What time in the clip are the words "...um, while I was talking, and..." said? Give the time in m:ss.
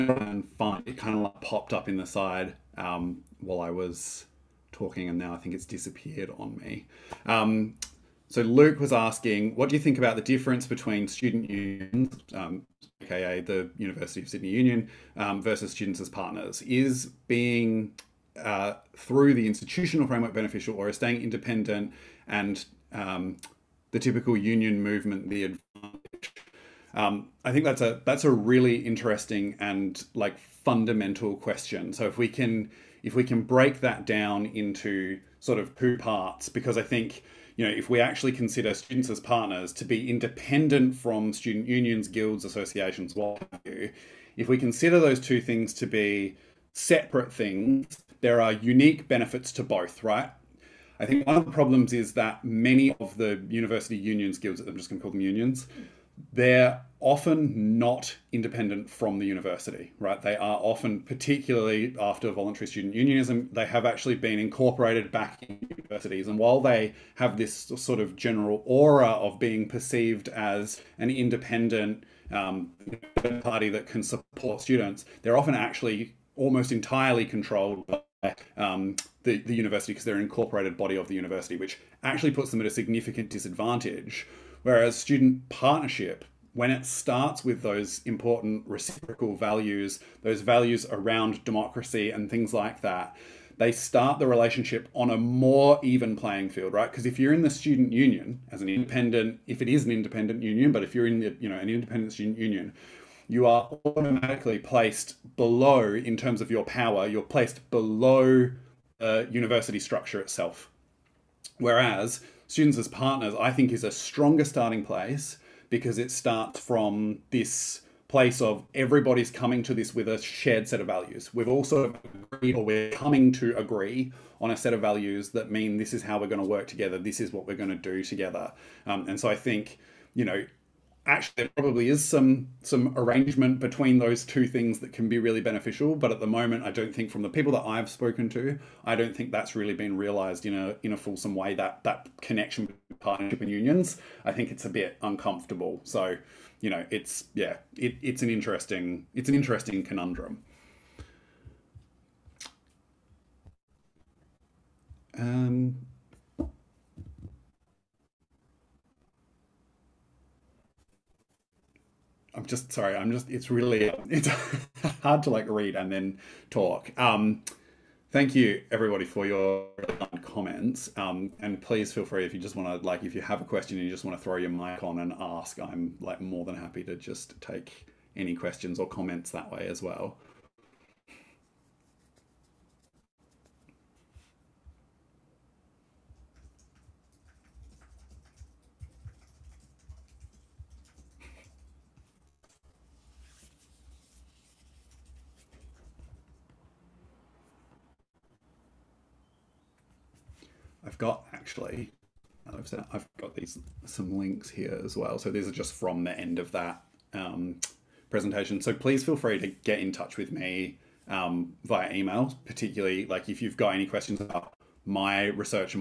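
0:02.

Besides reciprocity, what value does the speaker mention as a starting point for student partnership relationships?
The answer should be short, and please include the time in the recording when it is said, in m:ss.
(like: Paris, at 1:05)
Democracy, at 1:31.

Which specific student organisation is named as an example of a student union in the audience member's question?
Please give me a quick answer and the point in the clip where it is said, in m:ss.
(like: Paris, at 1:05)
University of Sydney Union, at 0:13.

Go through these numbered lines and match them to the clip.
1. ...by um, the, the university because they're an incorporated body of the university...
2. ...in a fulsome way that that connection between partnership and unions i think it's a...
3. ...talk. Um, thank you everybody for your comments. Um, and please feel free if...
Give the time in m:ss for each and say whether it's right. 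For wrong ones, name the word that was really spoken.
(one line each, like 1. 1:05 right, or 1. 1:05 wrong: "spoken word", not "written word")
1. 1:17 right
2. 2:20 right
3. 2:46 right.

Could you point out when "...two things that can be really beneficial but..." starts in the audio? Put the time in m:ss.
2:14.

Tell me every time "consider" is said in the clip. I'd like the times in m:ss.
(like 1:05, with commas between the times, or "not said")
0:38, 0:44.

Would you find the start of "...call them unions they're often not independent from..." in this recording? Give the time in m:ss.
0:55.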